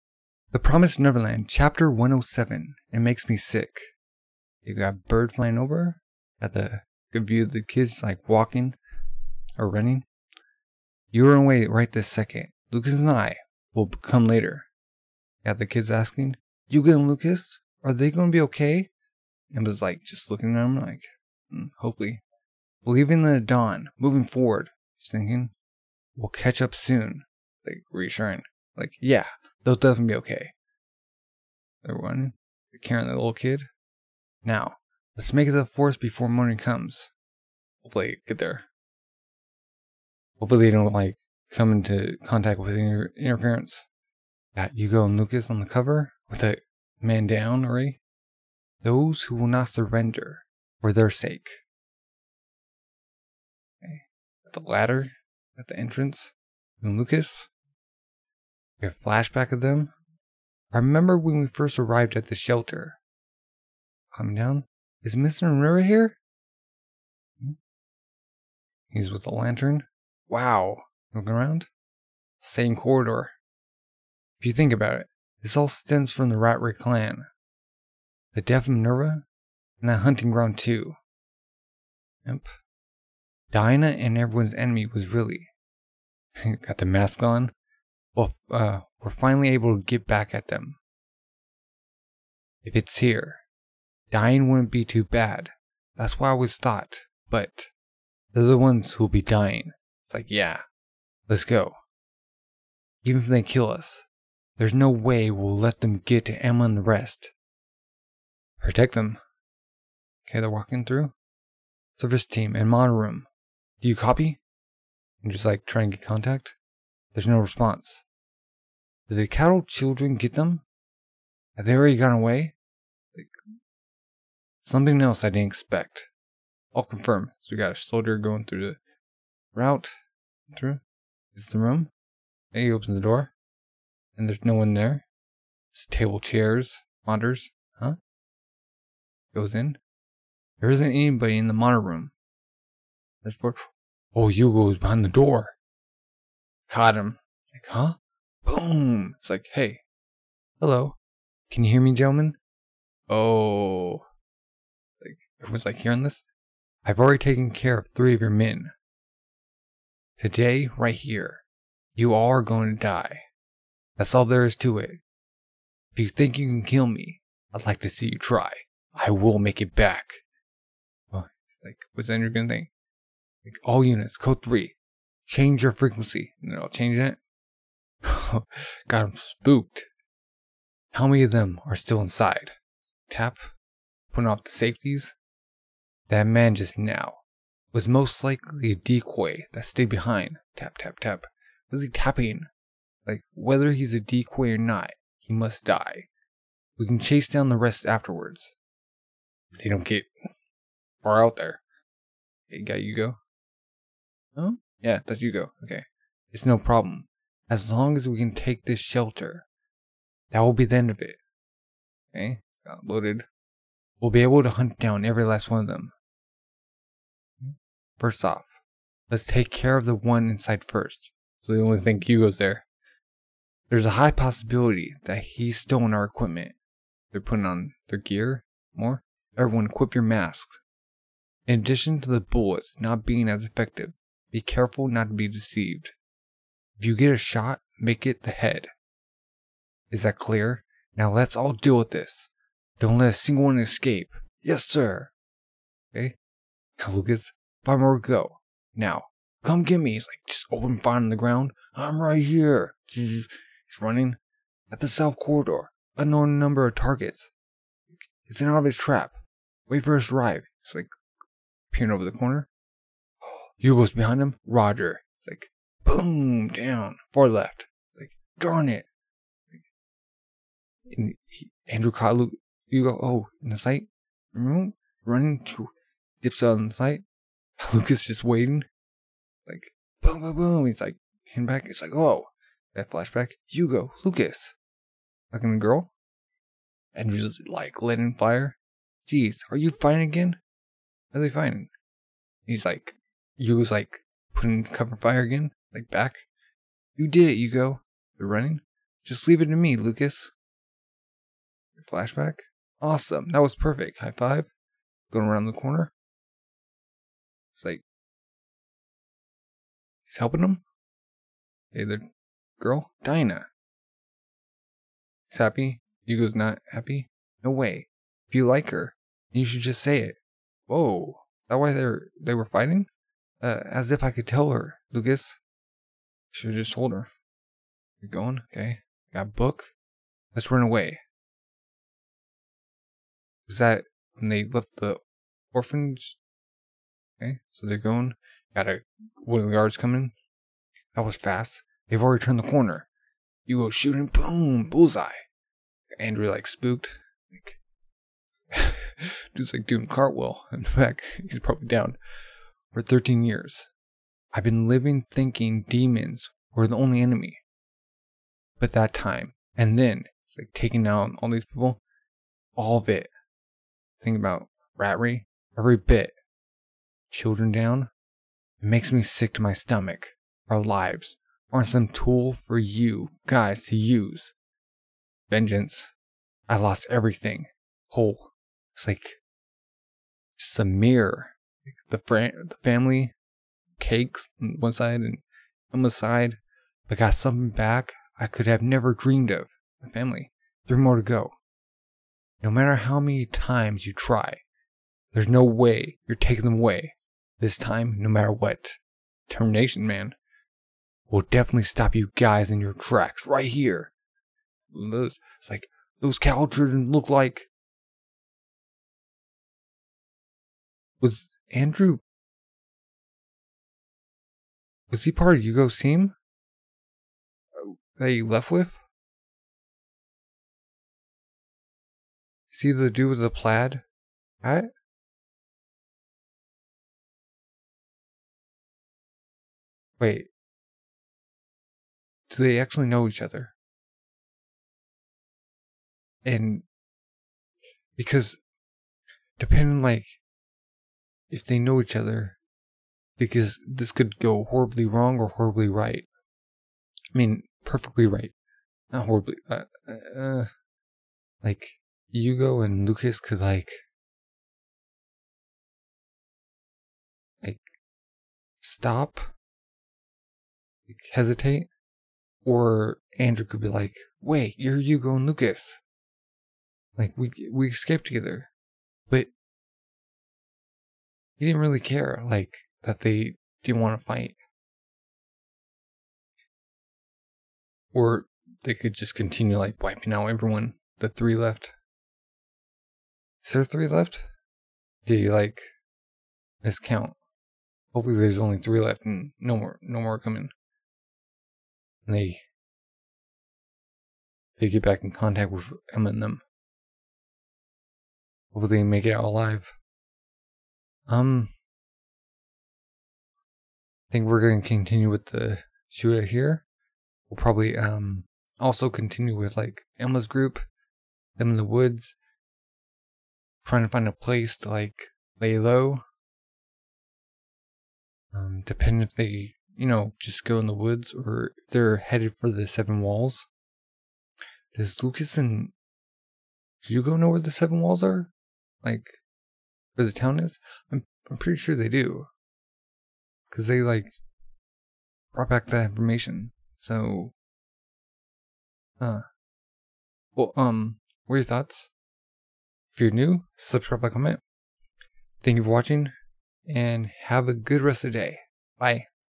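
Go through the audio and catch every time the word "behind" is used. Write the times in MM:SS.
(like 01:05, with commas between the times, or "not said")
02:24, 03:09, 04:23.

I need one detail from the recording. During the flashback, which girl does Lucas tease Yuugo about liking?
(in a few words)
Dinah.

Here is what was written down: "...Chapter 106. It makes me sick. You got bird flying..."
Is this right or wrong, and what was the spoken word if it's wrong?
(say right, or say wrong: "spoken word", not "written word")
wrong: "107", not "106".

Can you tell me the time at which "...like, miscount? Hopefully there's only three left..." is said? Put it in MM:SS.
08:05.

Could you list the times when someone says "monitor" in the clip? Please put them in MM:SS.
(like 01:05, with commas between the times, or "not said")
01:52, 02:17, 02:21.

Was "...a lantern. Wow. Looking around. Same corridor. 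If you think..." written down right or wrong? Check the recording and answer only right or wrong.
right.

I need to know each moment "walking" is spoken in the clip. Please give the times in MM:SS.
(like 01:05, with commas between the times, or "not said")
00:08, 01:50.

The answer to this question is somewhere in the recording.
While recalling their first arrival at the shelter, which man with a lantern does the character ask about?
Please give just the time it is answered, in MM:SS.
01:05.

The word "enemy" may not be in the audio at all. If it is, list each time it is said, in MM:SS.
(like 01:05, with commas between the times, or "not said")
01:24, 05:57.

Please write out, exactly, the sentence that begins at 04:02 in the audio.
Don't let a single one escape.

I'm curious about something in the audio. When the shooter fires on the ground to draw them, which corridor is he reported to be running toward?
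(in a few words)
South corridor.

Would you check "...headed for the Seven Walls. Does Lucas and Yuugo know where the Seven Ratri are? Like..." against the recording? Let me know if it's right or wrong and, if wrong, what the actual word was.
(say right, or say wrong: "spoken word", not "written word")
wrong: "Walls", not "Ratri".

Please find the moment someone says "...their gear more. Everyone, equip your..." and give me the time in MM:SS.
03:47.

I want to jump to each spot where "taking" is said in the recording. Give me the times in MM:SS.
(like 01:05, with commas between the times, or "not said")
06:00, 06:36.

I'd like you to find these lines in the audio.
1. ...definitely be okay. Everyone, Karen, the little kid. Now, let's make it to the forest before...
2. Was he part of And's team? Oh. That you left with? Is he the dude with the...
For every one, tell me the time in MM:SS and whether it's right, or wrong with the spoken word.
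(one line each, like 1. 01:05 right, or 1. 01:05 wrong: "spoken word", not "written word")
1. 00:29 right
2. 06:54 wrong: "Yuugo", not "And".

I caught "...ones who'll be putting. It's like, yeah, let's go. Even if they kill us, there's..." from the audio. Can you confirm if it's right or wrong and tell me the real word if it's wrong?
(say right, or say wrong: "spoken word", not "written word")
wrong: "dying", not "putting".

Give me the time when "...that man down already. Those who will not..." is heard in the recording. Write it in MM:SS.
00:46.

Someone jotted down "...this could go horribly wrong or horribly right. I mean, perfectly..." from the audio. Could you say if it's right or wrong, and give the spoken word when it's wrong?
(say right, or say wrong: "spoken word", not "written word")
right.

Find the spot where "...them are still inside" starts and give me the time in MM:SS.
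03:01.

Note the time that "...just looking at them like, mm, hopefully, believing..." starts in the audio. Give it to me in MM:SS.
00:20.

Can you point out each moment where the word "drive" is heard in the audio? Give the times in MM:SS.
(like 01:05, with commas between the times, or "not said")
04:20.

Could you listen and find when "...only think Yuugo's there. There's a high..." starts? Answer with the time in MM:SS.
03:41.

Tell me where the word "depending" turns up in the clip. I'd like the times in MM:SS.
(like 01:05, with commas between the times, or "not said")
07:19, 08:38.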